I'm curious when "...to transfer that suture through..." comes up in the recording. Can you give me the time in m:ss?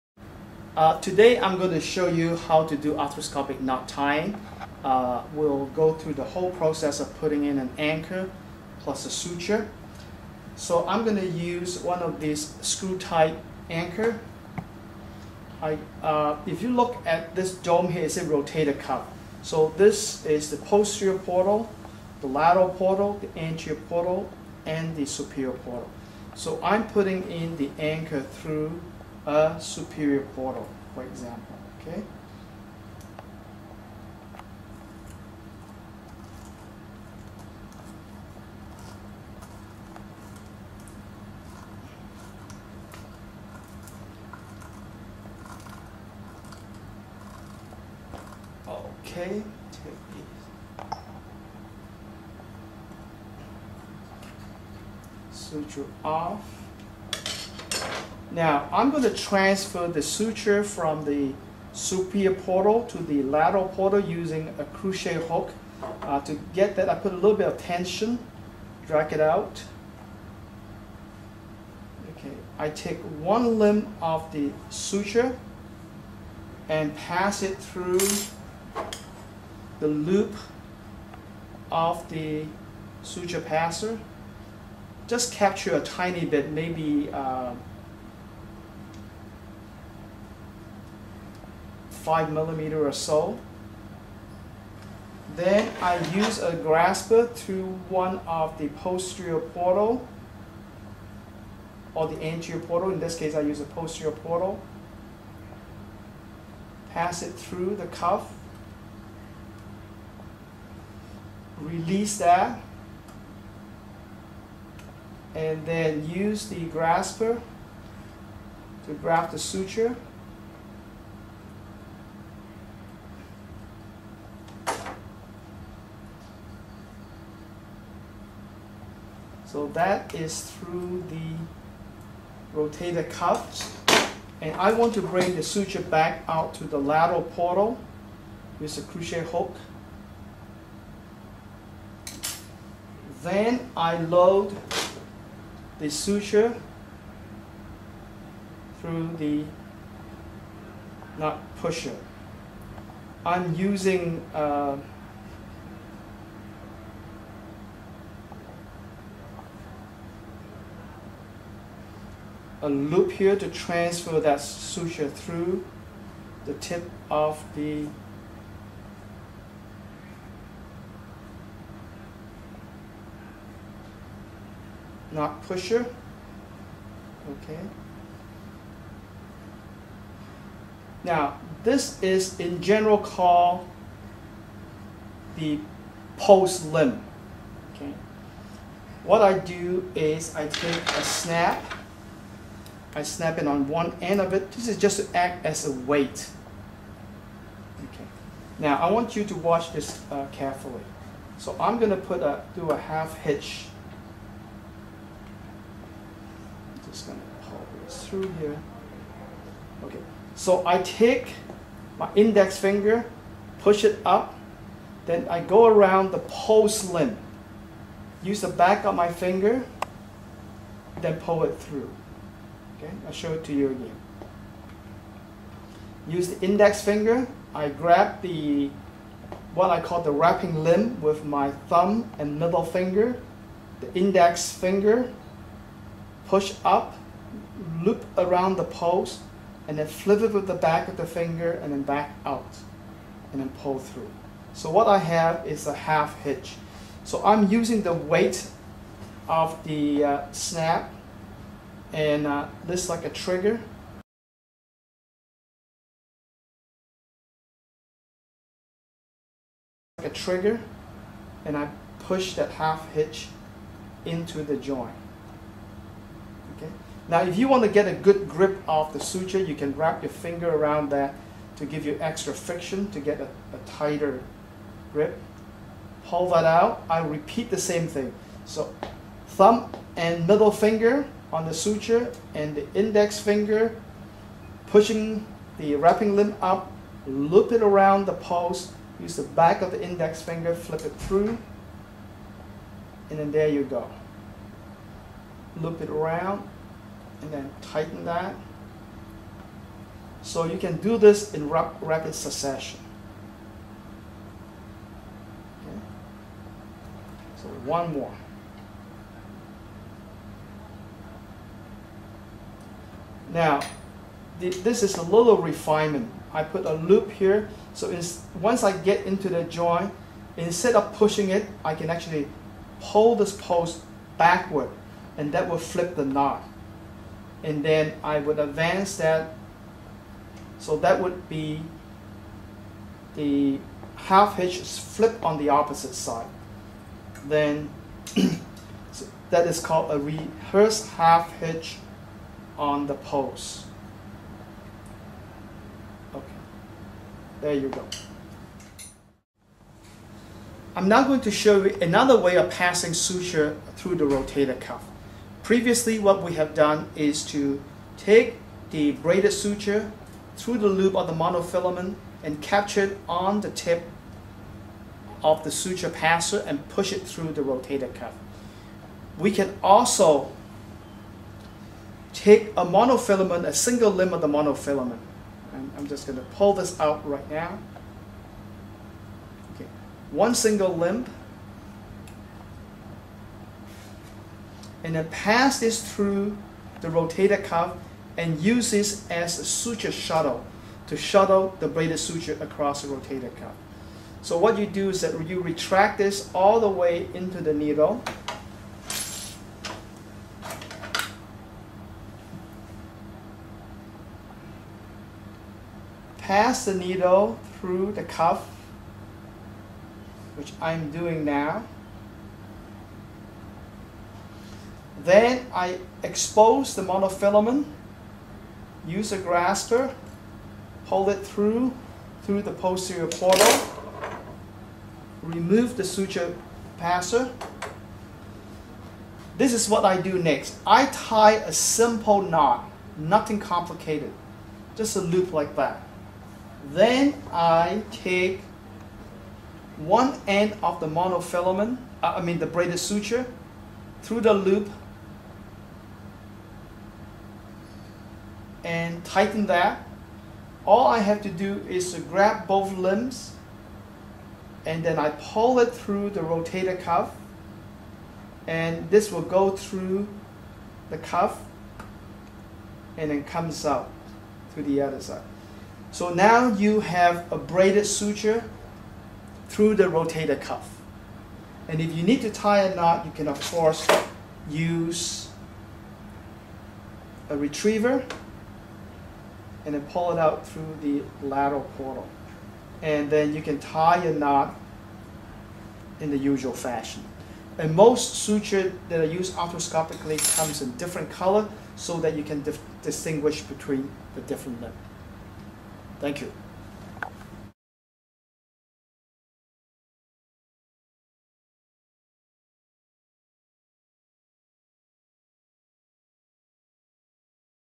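2:43.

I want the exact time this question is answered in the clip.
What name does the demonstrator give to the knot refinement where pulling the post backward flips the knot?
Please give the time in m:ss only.
5:39.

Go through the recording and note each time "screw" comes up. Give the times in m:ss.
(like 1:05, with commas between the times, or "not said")
0:12.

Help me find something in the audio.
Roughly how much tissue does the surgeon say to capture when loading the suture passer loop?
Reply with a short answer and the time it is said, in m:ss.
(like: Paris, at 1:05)
5 millimeter, at 1:32.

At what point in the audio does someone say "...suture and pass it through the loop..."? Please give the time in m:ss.
1:14.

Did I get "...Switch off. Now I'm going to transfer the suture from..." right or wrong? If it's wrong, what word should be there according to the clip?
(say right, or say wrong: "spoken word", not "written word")
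right.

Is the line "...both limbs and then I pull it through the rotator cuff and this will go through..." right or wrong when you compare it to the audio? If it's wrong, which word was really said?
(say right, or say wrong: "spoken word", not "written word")
right.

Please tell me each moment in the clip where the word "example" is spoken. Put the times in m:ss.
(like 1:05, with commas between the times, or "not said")
0:31.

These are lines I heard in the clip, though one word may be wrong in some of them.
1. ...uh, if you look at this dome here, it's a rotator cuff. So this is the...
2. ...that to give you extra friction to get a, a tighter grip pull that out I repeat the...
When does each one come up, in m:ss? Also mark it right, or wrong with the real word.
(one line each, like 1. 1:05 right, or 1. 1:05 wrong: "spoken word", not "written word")
1. 0:16 right
2. 4:30 right.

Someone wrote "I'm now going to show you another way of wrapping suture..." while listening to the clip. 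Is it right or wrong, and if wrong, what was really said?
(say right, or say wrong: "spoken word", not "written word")
wrong: "passing", not "wrapping".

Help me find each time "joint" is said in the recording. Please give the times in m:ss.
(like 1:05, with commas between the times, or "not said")
4:24, 5:19.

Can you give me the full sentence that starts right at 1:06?
Uh, to get that, I put a little bit of tension, drag it out.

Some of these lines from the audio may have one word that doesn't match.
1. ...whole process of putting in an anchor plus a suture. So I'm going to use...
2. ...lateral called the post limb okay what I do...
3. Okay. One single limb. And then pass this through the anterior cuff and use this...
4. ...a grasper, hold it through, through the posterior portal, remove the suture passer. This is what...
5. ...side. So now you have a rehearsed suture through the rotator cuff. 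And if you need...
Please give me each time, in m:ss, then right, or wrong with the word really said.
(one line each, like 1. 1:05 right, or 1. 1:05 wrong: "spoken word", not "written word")
1. 0:06 right
2. 3:02 wrong: "general", not "lateral"
3. 6:19 wrong: "rotator", not "anterior"
4. 6:59 right
5. 7:45 wrong: "braided", not "rehearsed".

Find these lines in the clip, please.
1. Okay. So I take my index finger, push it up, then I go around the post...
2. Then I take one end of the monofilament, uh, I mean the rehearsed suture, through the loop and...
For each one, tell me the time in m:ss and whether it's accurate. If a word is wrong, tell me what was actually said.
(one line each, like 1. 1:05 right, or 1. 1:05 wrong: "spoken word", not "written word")
1. 3:29 right
2. 7:16 wrong: "braided", not "rehearsed".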